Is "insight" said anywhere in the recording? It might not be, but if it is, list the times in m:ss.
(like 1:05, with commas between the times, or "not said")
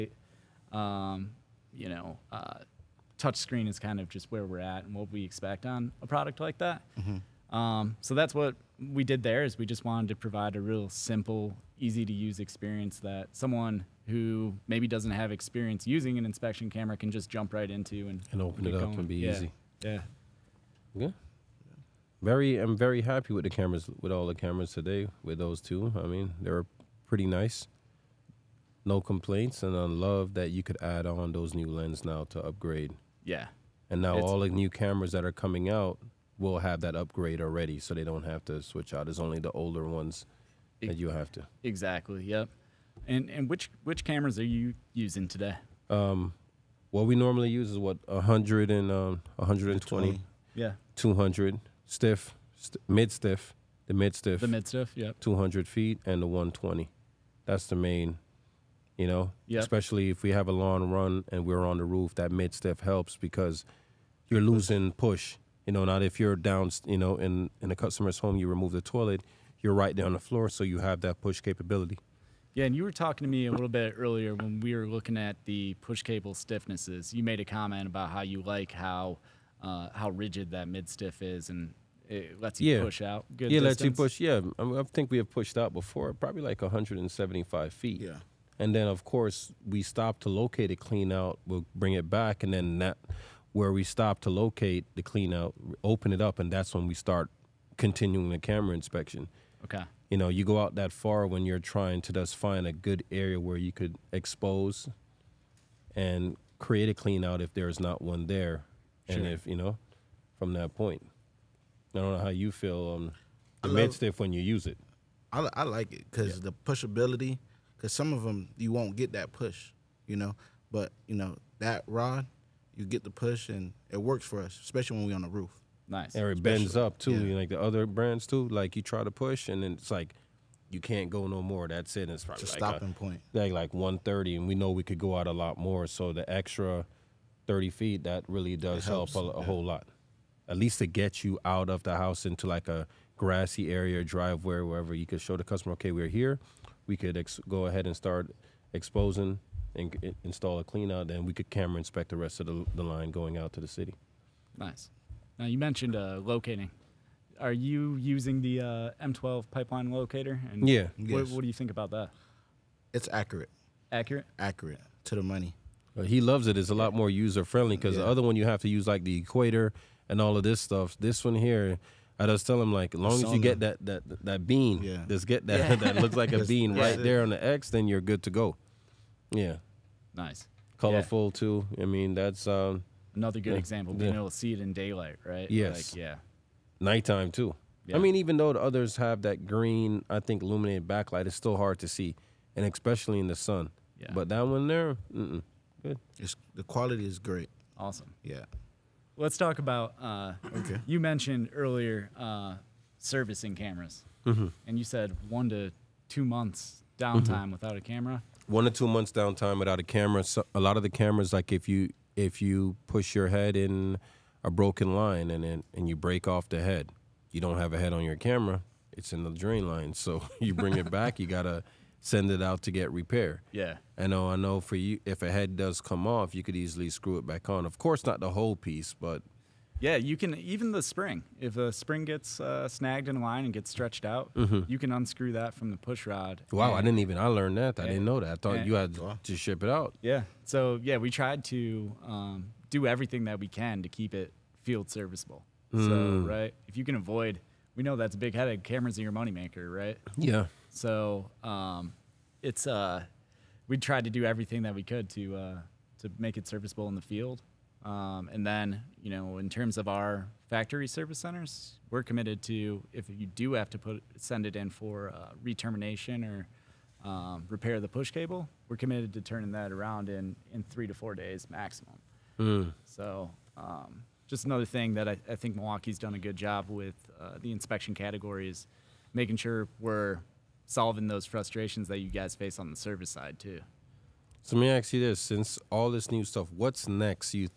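not said.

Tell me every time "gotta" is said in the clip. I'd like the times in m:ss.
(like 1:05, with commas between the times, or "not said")
3:41.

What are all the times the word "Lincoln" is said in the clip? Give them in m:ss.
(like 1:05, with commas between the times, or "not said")
not said.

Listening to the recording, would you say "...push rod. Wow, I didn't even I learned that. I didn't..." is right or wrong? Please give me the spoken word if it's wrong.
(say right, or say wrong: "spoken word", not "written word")
right.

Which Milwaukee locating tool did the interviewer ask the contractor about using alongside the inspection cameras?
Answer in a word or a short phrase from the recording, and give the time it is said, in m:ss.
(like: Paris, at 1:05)
M12 pipeline locator, at 2:39.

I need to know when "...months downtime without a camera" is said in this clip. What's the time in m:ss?
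3:28.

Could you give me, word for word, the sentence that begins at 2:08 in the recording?
Like you try to push, and then it's like you can't go no more.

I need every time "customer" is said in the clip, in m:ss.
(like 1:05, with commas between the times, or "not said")
1:07, 2:25.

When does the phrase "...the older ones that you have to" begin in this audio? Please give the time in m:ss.
0:39.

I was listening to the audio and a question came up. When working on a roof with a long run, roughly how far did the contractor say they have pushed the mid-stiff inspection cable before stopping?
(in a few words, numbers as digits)
175 feet.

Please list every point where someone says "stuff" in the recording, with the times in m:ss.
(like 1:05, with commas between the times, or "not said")
2:50, 4:46.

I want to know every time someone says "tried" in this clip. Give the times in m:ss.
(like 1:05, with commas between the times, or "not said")
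4:01, 4:13.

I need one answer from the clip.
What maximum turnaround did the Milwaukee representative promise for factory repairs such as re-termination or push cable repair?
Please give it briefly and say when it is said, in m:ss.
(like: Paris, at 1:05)
3 to 4 days, at 4:30.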